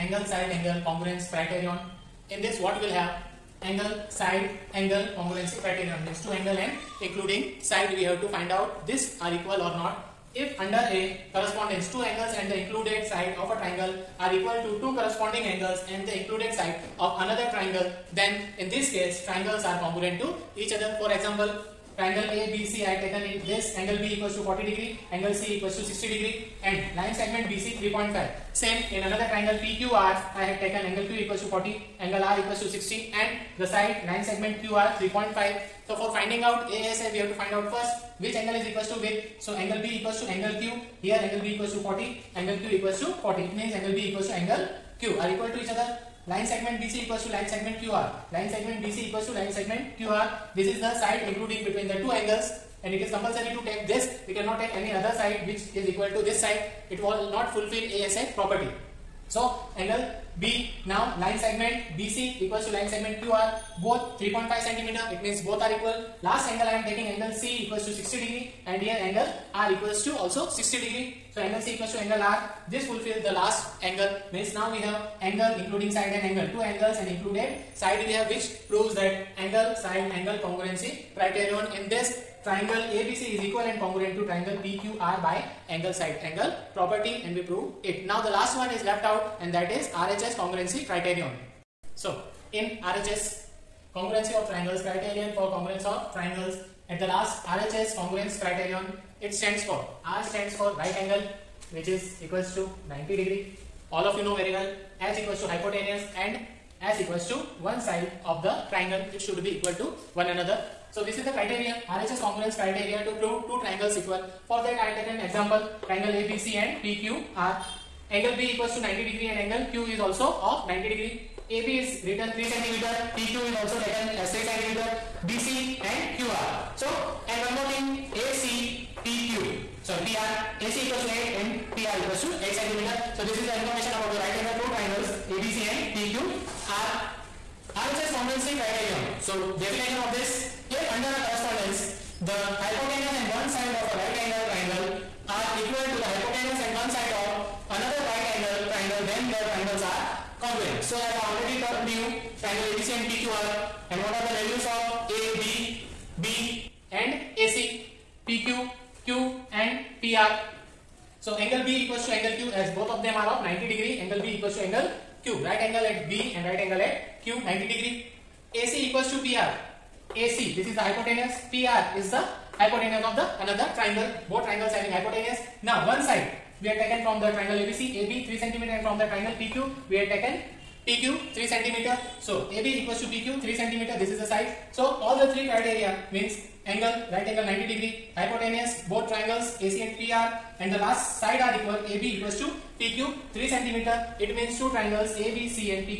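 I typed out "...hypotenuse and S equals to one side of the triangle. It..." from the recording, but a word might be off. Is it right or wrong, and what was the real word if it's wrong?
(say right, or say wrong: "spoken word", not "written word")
right.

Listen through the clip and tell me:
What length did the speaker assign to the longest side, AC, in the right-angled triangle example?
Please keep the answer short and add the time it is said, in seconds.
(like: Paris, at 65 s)
8 cm, at 130 s.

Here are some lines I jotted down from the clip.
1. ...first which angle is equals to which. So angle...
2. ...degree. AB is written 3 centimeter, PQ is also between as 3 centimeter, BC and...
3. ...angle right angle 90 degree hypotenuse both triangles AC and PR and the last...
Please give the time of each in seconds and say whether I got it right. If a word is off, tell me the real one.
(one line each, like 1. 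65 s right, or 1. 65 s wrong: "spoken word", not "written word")
1. 37 s right
2. 120 s wrong: "taken", not "between"
3. 186 s right.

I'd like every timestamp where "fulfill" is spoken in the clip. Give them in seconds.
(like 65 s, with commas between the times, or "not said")
57 s, 72 s.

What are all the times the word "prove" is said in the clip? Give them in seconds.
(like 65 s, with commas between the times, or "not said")
78 s, 87 s, 113 s.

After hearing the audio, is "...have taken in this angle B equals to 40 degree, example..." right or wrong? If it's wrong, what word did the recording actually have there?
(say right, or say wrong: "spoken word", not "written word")
wrong: "angle", not "example".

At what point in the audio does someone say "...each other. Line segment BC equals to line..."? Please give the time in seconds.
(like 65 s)
45 s.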